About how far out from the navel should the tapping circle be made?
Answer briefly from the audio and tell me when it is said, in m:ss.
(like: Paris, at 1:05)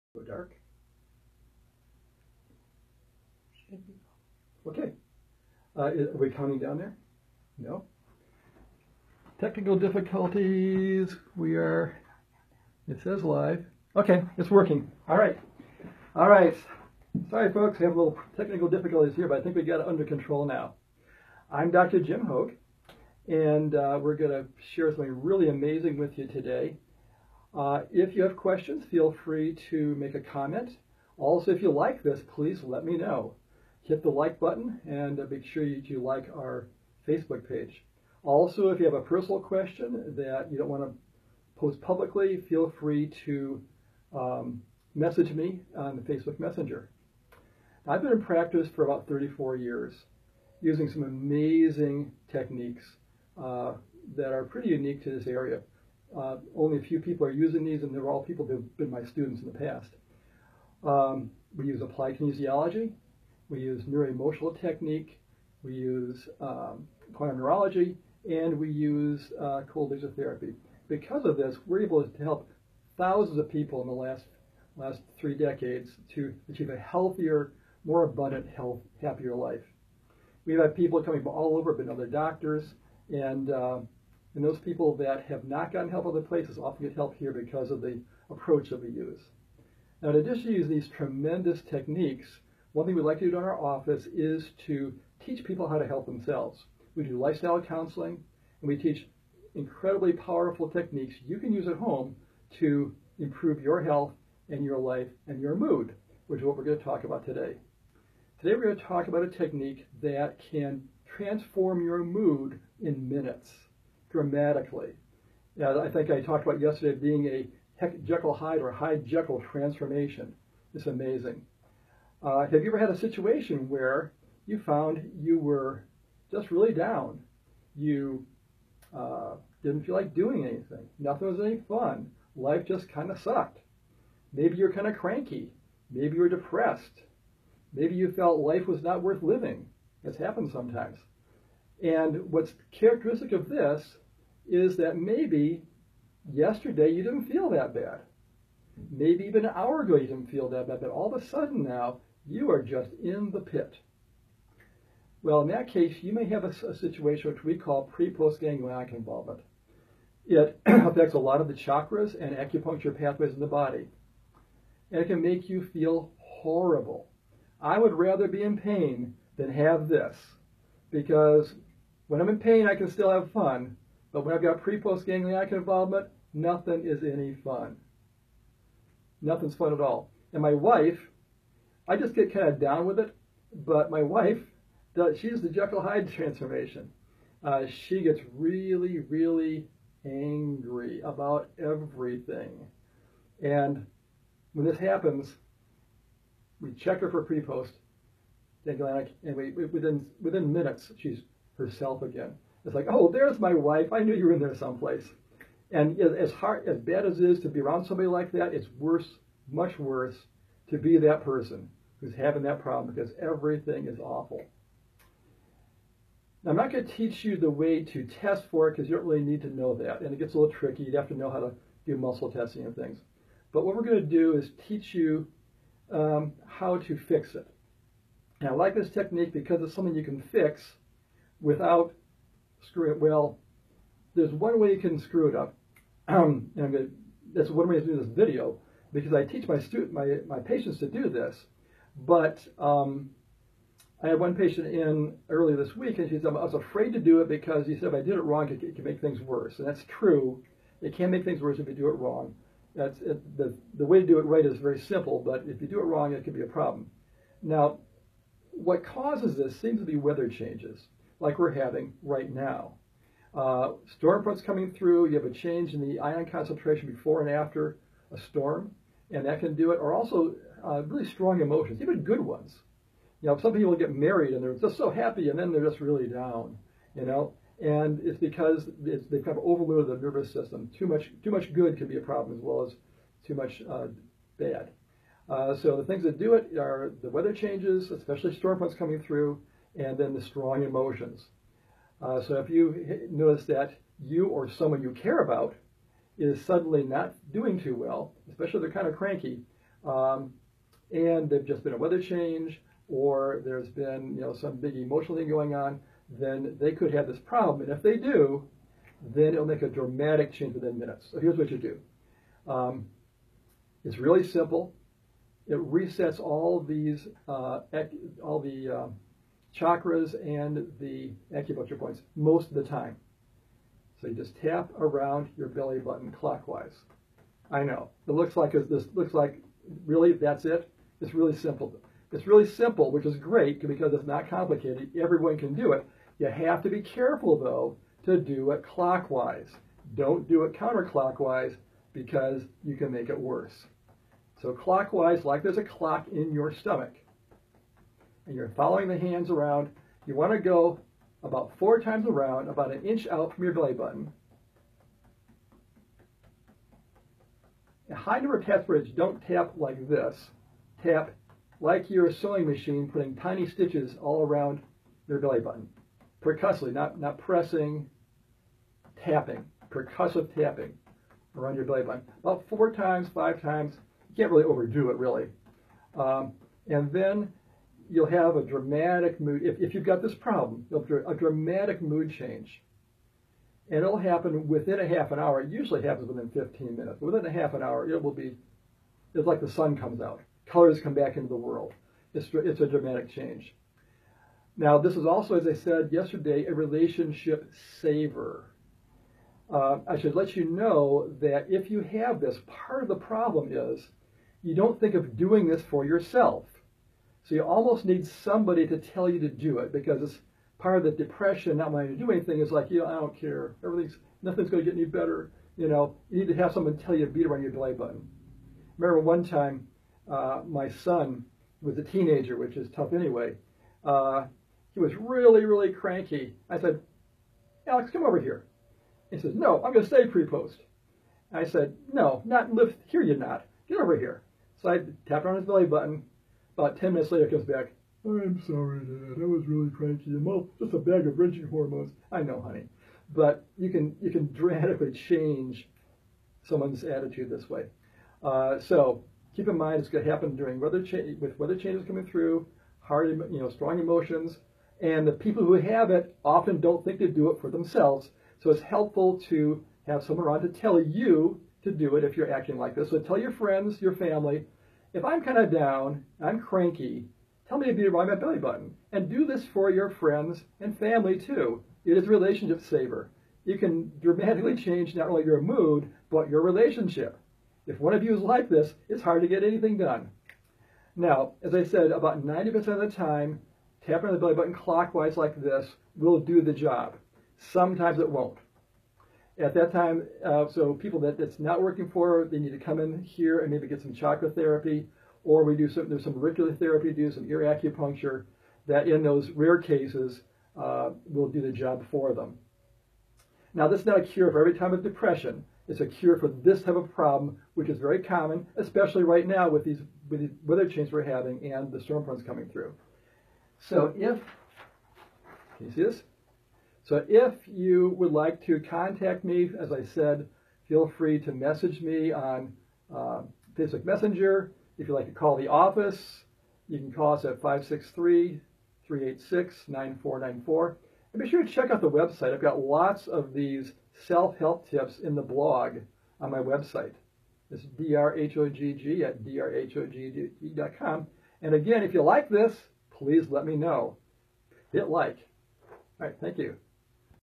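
an inch, at 5:52.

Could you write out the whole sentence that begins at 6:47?
So you almost need somebody to tell you to do it because it's part of the depression, not wanting to do anything.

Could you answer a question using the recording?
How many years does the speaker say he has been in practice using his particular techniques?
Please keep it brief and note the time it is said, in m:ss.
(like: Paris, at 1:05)
34, at 0:49.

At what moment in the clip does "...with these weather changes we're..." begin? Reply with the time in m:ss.
8:30.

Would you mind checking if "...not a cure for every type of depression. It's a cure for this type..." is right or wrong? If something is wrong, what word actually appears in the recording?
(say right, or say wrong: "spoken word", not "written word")
right.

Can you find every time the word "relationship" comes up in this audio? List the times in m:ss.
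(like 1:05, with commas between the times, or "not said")
6:36, 7:52, 7:56.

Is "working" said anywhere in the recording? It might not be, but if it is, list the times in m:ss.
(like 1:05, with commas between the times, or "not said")
0:14, 8:11.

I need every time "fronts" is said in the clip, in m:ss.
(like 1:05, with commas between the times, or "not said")
4:24, 4:48, 8:32.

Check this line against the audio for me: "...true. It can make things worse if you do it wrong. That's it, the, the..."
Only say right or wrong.
right.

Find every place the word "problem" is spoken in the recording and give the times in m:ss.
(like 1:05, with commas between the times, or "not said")
3:32, 4:16, 4:42, 5:07, 6:20, 6:42, 8:26.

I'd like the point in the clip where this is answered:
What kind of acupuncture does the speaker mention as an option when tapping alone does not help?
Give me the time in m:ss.
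8:17.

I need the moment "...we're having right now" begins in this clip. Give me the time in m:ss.
4:21.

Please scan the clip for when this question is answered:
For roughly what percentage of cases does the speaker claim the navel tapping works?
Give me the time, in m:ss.
8:02.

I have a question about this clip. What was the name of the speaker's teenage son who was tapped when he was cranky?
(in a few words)
Alex.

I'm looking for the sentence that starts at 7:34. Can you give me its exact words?
And the people who have it often don't think to do it for themselves.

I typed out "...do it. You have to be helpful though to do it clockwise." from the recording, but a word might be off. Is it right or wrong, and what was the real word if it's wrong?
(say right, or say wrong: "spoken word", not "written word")
wrong: "careful", not "helpful".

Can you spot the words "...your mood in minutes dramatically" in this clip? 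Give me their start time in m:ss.
1:51.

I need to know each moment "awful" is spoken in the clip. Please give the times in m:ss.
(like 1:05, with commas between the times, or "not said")
3:33.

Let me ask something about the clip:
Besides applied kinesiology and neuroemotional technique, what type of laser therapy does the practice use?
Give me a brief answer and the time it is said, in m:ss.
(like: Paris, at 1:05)
cold laser therapy, at 1:09.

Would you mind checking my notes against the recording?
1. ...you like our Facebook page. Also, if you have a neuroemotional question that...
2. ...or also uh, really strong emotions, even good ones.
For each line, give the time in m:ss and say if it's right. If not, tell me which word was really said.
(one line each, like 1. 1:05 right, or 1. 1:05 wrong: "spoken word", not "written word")
1. 0:35 wrong: "personal", not "neuroemotional"
2. 4:29 right.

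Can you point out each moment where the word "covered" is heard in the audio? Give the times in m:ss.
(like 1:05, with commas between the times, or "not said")
not said.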